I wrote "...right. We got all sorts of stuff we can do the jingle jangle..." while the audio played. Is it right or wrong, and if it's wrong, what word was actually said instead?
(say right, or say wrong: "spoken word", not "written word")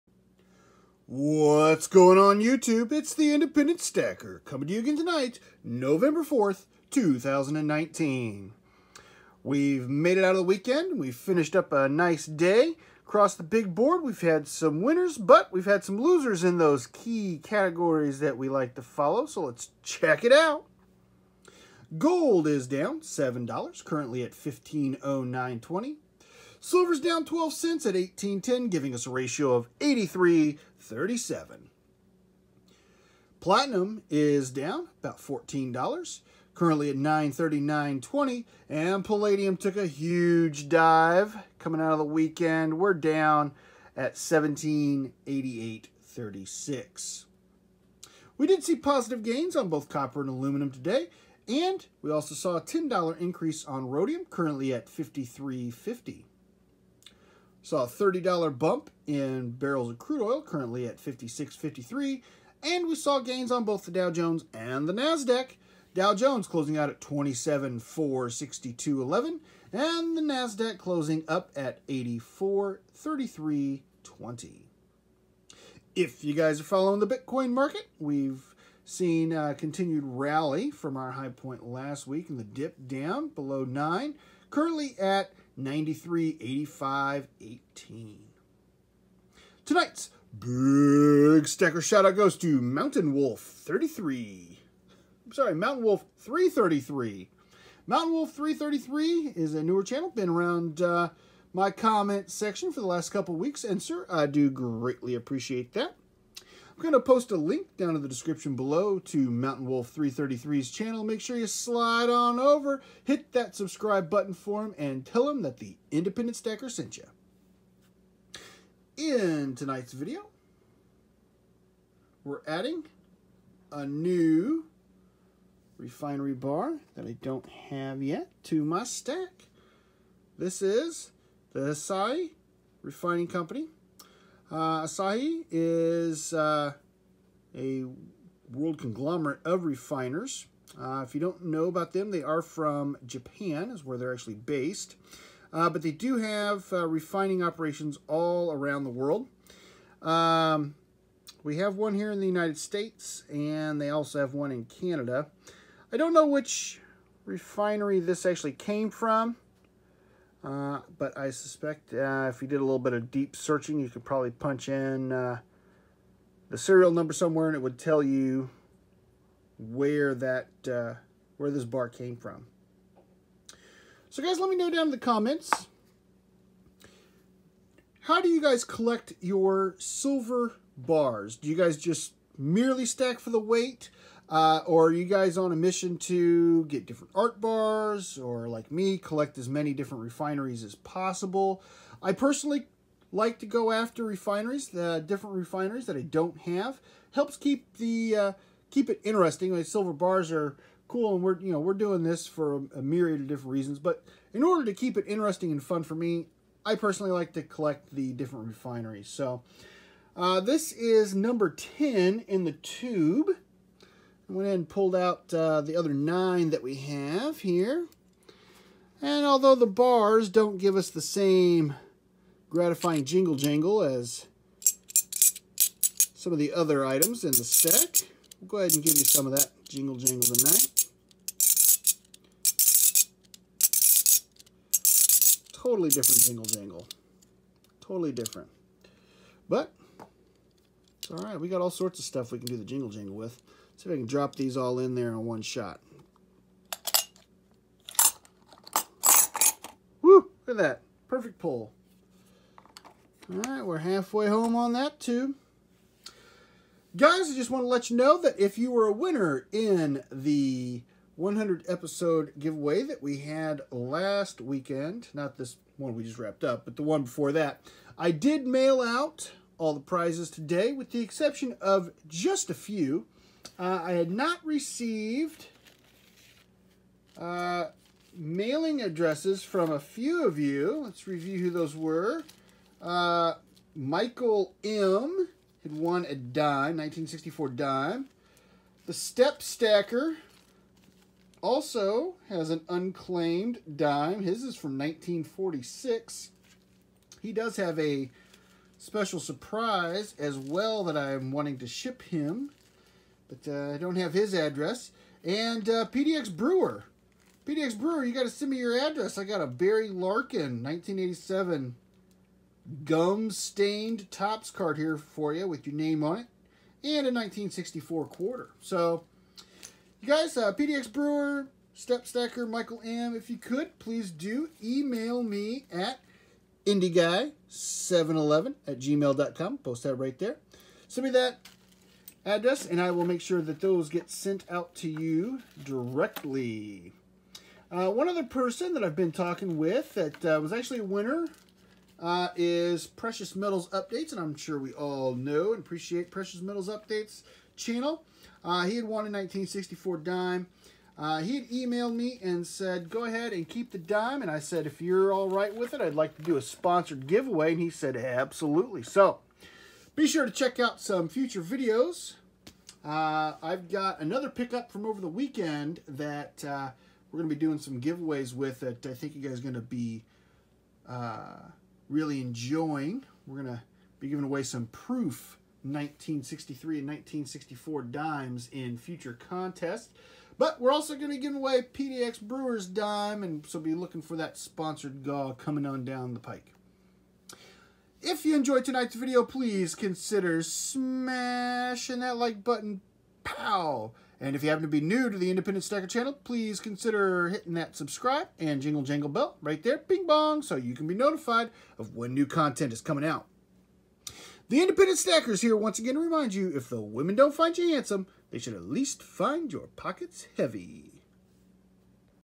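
right.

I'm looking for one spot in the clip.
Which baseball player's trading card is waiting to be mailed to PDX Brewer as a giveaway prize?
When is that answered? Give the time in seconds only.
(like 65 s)
309 s.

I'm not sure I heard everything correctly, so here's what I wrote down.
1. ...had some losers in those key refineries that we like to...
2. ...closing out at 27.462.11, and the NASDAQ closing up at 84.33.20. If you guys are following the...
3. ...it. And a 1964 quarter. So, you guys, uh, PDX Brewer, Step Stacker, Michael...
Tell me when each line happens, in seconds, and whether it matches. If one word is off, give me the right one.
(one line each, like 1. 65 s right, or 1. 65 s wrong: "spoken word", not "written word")
1. 15 s wrong: "categories", not "refineries"
2. 66 s right
3. 316 s right.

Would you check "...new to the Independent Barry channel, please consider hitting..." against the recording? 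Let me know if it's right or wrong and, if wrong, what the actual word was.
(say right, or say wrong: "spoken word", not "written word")
wrong: "Stacker", not "Barry".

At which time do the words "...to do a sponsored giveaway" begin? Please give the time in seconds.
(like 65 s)
356 s.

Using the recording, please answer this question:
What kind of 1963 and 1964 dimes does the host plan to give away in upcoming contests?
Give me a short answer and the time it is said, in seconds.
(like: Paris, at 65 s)
Proof, at 374 s.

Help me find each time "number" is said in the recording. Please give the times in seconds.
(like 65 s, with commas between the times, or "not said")
166 s, 211 s.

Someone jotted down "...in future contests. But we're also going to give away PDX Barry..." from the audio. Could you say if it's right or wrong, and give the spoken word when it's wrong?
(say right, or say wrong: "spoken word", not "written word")
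wrong: "Brewers", not "Barry".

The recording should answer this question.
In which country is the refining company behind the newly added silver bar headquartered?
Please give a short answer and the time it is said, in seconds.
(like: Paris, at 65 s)
Japan, at 143 s.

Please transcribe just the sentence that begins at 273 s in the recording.
Uh, I had not received uh, mailing addresses from a few of you.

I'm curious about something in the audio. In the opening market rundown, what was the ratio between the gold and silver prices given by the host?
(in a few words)
83.37.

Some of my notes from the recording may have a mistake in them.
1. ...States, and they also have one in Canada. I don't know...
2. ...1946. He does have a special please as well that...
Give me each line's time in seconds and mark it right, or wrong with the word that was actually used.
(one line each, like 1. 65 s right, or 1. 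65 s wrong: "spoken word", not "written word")
1. 152 s right
2. 294 s wrong: "surprise", not "please".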